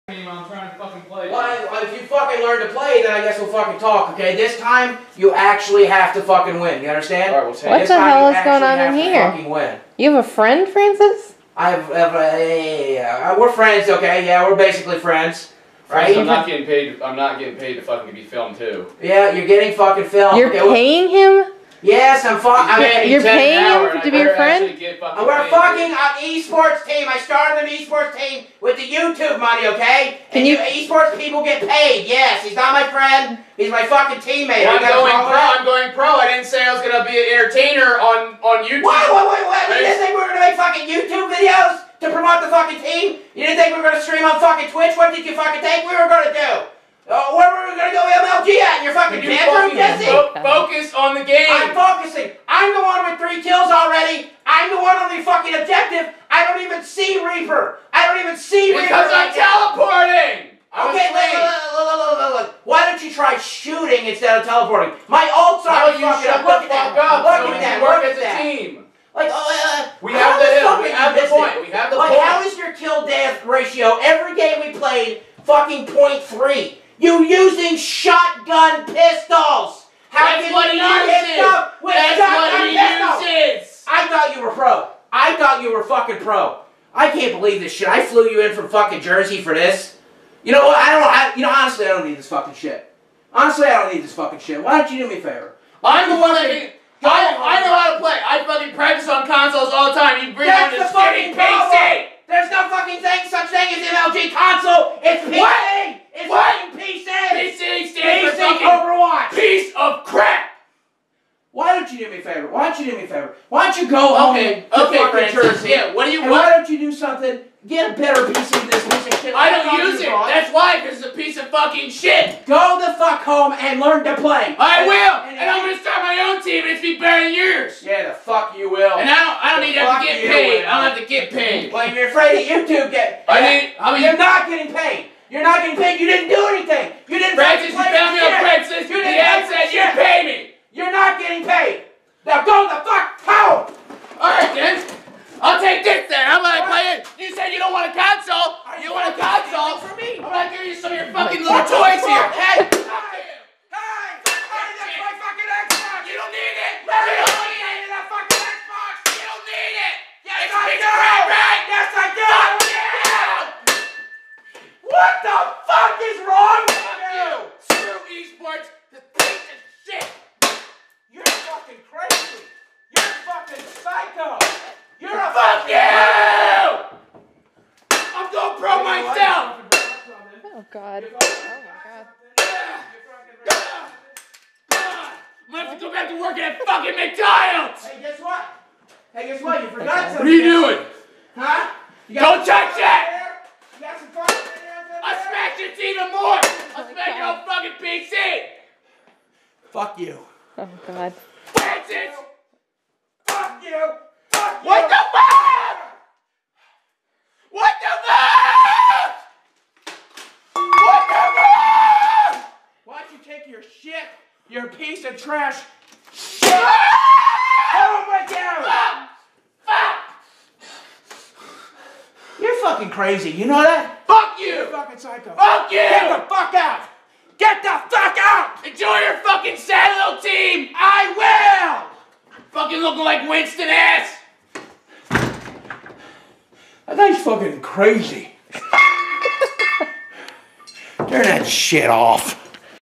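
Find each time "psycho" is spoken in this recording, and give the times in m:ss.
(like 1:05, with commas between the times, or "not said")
2:53, 3:44.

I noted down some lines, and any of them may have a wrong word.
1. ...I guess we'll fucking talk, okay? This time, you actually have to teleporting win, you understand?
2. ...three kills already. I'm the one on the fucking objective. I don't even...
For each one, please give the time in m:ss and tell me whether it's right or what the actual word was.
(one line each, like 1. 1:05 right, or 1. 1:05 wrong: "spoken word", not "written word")
1. 0:03 wrong: "fucking", not "teleporting"
2. 0:53 right.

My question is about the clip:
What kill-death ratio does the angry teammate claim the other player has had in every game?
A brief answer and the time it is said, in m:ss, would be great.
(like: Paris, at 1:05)
0.3, at 1:15.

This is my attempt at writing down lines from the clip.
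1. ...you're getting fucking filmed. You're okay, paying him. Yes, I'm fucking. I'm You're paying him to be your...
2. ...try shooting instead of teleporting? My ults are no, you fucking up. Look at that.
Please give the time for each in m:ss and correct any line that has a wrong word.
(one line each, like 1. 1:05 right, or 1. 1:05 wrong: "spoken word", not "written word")
1. 0:19 right
2. 1:03 right.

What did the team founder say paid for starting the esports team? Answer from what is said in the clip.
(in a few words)
YouTube money.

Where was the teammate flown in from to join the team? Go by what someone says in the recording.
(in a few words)
Jersey.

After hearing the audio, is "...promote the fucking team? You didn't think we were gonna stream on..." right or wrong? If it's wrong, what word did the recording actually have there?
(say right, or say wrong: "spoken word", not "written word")
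right.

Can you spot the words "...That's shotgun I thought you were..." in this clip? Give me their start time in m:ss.
1:21.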